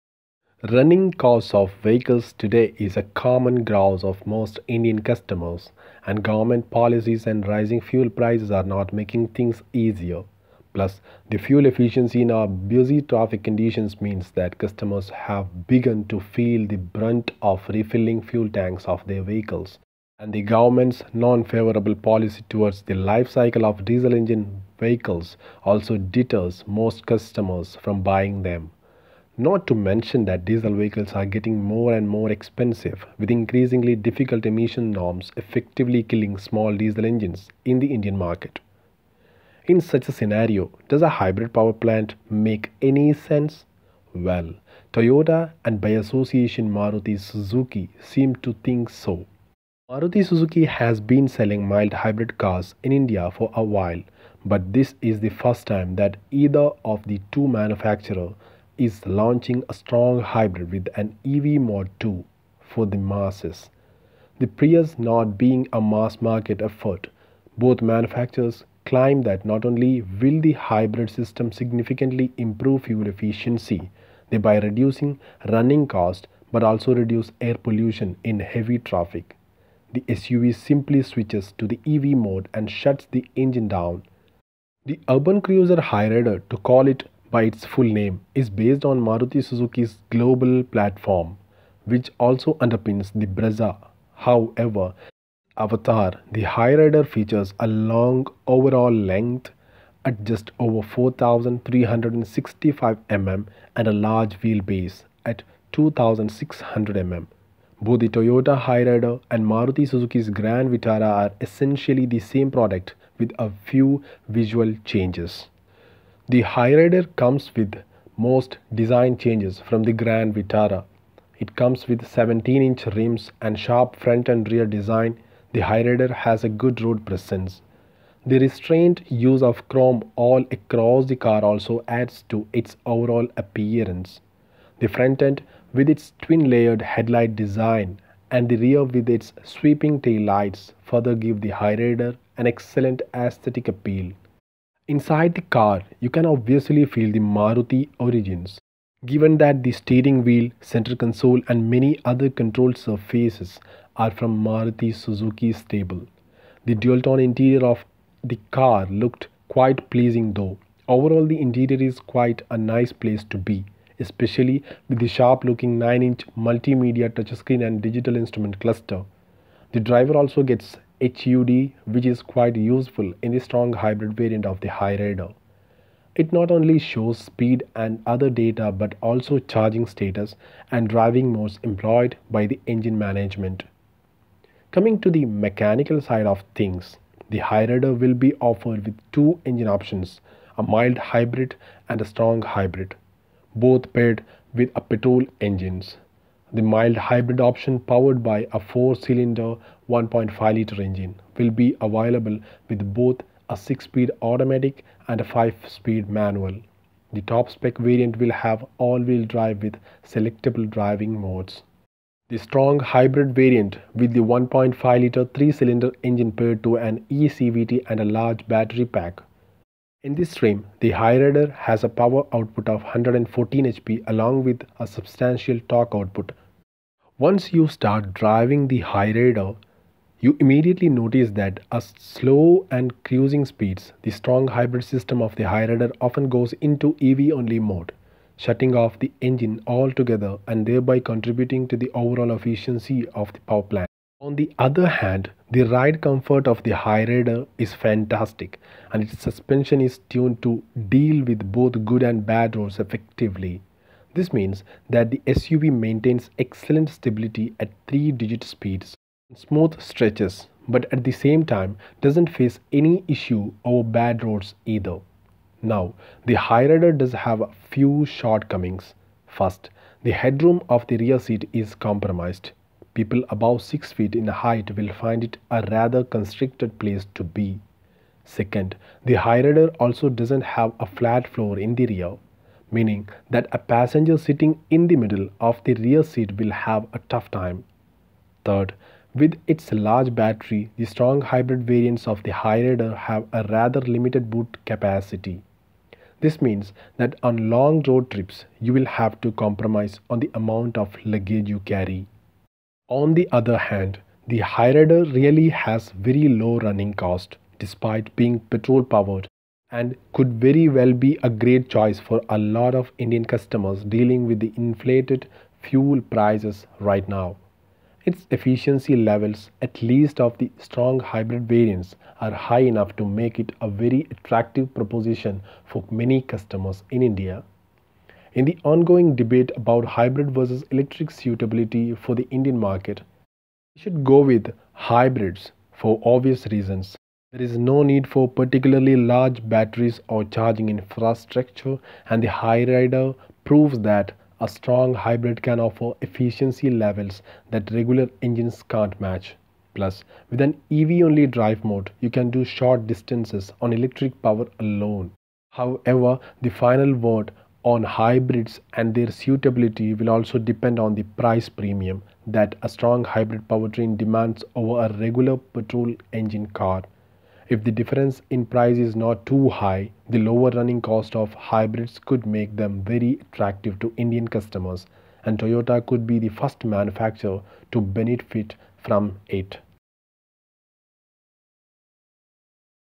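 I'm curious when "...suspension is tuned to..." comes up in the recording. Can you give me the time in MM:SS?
04:09.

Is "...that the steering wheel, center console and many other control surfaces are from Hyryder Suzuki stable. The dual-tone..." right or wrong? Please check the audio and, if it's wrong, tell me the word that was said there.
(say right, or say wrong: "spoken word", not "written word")
wrong: "Maruti", not "Hyryder".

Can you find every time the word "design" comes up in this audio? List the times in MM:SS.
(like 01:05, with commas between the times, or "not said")
01:58, 02:04, 02:17.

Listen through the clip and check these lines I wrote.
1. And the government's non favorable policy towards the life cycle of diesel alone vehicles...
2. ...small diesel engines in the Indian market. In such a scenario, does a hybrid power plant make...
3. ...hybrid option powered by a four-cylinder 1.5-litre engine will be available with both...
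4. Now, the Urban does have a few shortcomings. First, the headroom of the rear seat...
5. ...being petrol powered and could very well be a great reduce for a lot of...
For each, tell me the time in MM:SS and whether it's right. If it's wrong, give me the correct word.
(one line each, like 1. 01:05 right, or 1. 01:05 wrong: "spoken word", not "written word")
1. 00:20 wrong: "engine", not "alone"
2. 00:36 right
3. 03:16 right
4. 04:25 wrong: "Hyryder", not "Urban"
5. 05:08 wrong: "choice", not "reduce".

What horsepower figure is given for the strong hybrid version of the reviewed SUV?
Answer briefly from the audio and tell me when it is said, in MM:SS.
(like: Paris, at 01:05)
114 HP, at 03:42.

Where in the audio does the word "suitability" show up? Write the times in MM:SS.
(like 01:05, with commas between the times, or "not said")
05:31, 05:59.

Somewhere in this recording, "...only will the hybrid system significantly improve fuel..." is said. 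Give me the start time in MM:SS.
01:09.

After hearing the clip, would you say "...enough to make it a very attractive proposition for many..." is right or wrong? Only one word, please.
right.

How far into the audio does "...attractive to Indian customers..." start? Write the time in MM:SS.
06:13.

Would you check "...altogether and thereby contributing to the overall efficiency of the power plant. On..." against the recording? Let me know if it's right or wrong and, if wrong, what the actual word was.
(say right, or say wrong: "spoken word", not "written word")
right.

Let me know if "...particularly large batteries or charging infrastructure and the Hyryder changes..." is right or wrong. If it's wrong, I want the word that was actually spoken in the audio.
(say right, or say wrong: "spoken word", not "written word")
wrong: "proves", not "changes".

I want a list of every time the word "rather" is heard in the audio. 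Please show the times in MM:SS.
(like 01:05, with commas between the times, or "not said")
04:35, 04:53.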